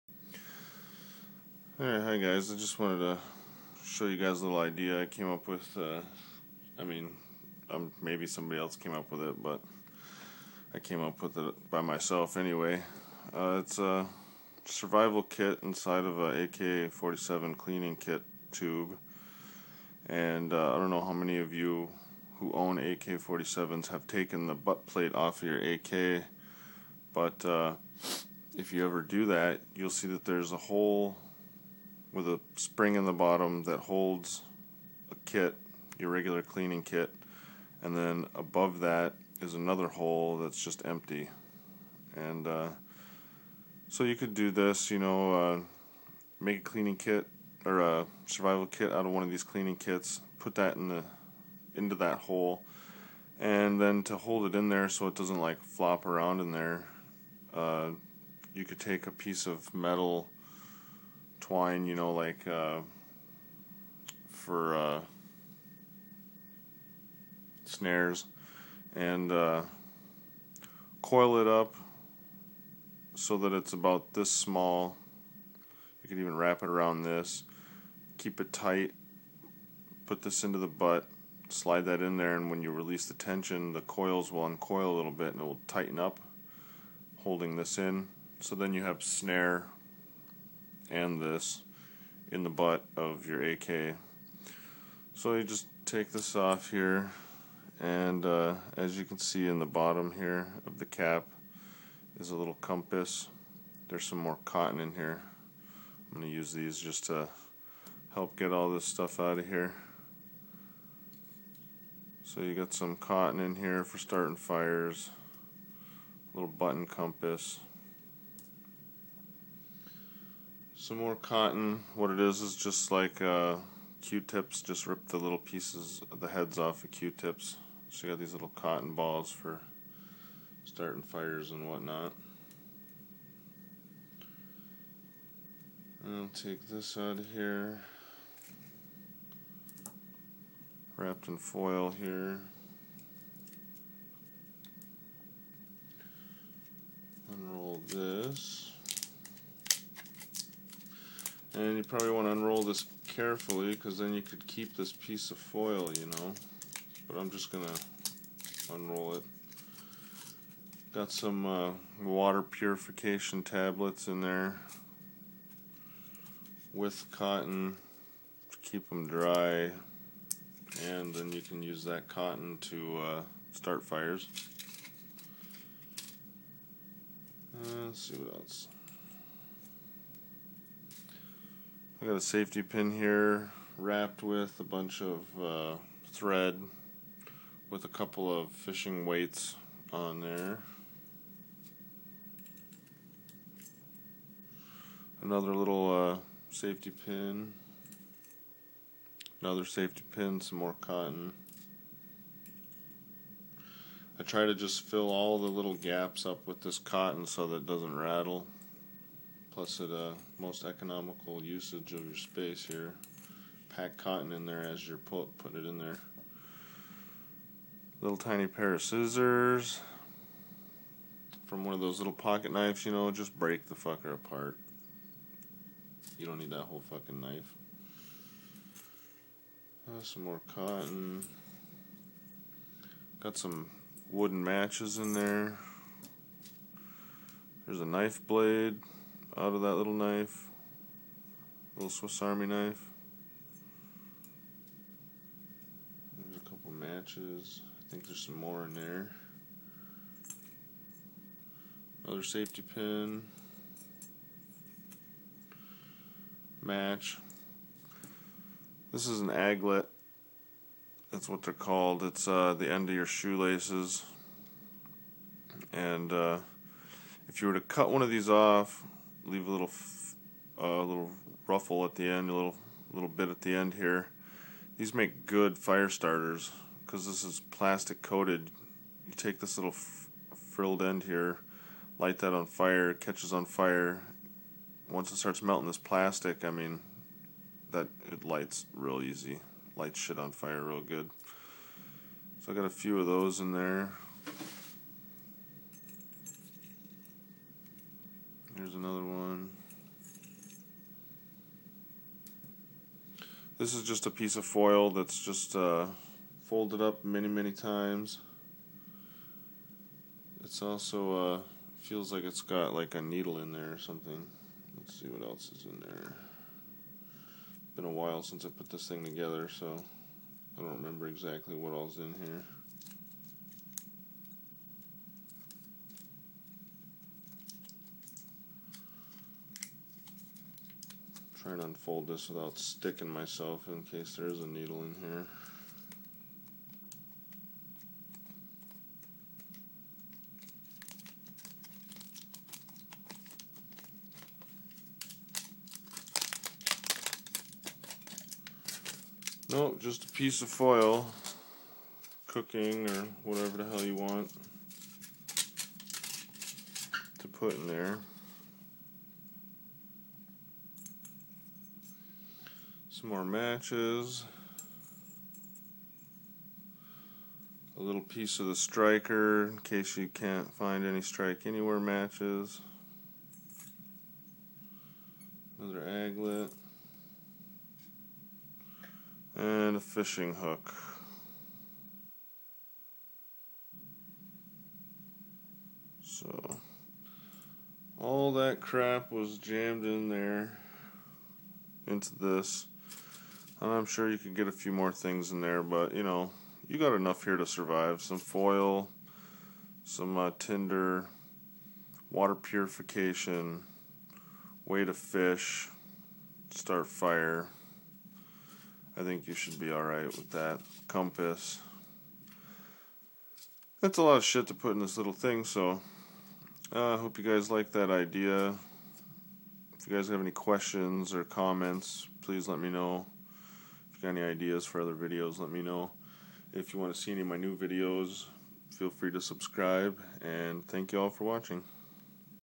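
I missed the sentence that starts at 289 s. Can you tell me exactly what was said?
Lights shit on fire real good.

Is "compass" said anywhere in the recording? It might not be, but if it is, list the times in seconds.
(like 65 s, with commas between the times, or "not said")
102 s, 116 s, 410 s.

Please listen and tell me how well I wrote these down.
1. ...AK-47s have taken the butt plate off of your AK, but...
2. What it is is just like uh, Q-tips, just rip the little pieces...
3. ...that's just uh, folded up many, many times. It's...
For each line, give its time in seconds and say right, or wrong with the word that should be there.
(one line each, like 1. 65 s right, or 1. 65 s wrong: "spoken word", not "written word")
1. 22 s right
2. 121 s right
3. 304 s right.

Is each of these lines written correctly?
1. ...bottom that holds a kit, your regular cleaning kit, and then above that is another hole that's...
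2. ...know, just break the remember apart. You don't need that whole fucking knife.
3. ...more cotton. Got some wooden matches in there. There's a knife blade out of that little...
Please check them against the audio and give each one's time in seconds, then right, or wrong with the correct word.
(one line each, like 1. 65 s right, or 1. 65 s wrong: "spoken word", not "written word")
1. 33 s right
2. 222 s wrong: "fucker", not "remember"
3. 230 s right.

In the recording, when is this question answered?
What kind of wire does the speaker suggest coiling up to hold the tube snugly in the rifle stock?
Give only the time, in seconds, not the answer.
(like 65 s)
59 s.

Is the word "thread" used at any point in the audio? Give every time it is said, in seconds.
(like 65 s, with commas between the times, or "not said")
186 s.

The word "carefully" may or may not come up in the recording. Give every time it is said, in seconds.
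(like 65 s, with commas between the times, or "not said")
153 s.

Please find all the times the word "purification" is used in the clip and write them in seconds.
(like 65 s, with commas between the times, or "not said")
162 s, 402 s.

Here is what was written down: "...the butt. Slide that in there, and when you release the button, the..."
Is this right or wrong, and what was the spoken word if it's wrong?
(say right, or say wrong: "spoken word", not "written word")
wrong: "tension", not "button".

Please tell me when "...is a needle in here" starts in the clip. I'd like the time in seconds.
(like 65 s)
334 s.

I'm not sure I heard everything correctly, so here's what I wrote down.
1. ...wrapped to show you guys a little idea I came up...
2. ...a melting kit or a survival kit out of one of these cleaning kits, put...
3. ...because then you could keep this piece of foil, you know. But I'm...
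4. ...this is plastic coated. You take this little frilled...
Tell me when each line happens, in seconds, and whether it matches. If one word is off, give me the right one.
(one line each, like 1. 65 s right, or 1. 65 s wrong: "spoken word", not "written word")
1. 2 s wrong: "wanted", not "wrapped"
2. 46 s wrong: "cleaning", not "melting"
3. 153 s right
4. 277 s right.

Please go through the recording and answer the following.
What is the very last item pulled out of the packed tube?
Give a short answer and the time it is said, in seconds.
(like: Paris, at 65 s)
A fishing hook, at 379 s.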